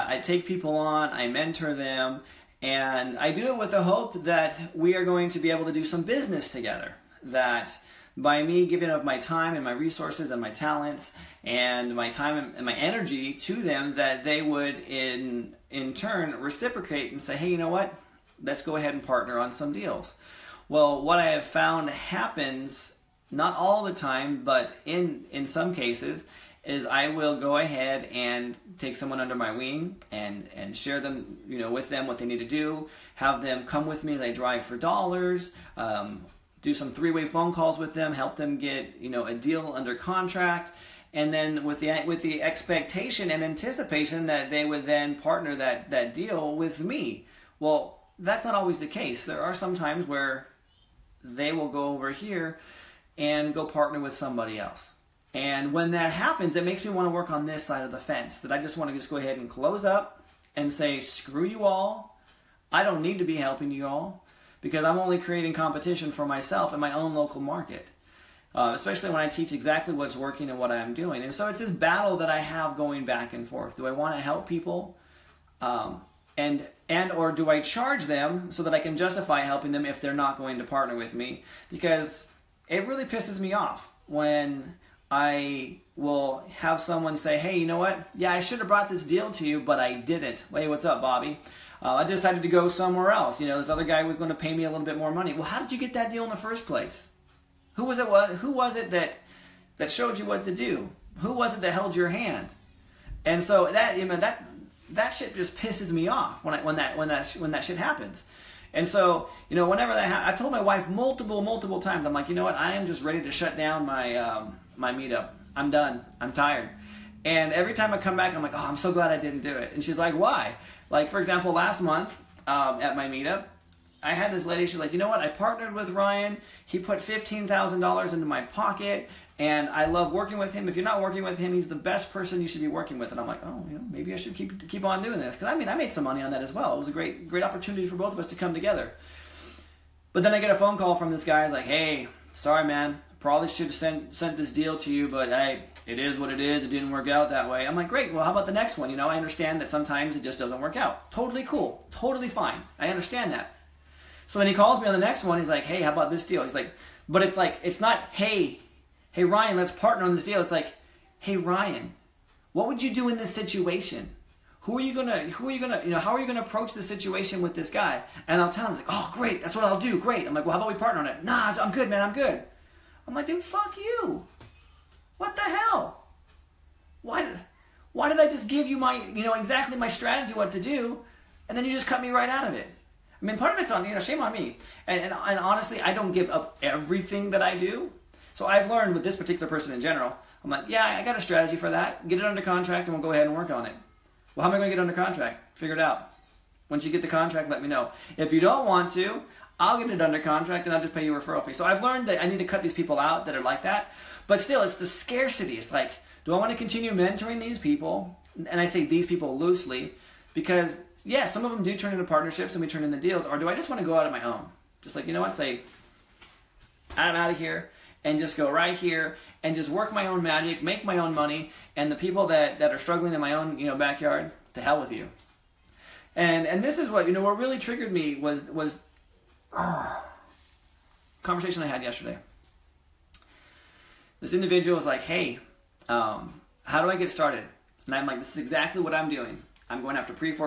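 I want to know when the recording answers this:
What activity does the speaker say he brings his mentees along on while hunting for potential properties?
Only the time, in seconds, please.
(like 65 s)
34 s.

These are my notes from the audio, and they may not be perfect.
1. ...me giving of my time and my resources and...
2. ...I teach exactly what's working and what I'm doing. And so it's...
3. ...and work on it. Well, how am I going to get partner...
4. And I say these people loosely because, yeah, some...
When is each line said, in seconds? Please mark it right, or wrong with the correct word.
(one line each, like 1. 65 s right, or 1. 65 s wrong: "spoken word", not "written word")
1. 8 s right
2. 69 s right
3. 193 s wrong: "under", not "partner"
4. 208 s right.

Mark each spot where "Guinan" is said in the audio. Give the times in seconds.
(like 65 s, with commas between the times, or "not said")
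not said.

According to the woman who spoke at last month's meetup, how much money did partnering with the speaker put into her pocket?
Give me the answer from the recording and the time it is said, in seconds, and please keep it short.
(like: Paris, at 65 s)
$15,000, at 126 s.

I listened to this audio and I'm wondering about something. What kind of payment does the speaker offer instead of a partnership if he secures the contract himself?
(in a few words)
referral fee.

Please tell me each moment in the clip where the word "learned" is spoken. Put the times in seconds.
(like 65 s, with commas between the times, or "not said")
188 s, 201 s.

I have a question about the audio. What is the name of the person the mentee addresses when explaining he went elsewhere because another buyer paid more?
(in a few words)
Bobby.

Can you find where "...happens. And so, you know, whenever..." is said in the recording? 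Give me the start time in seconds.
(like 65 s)
107 s.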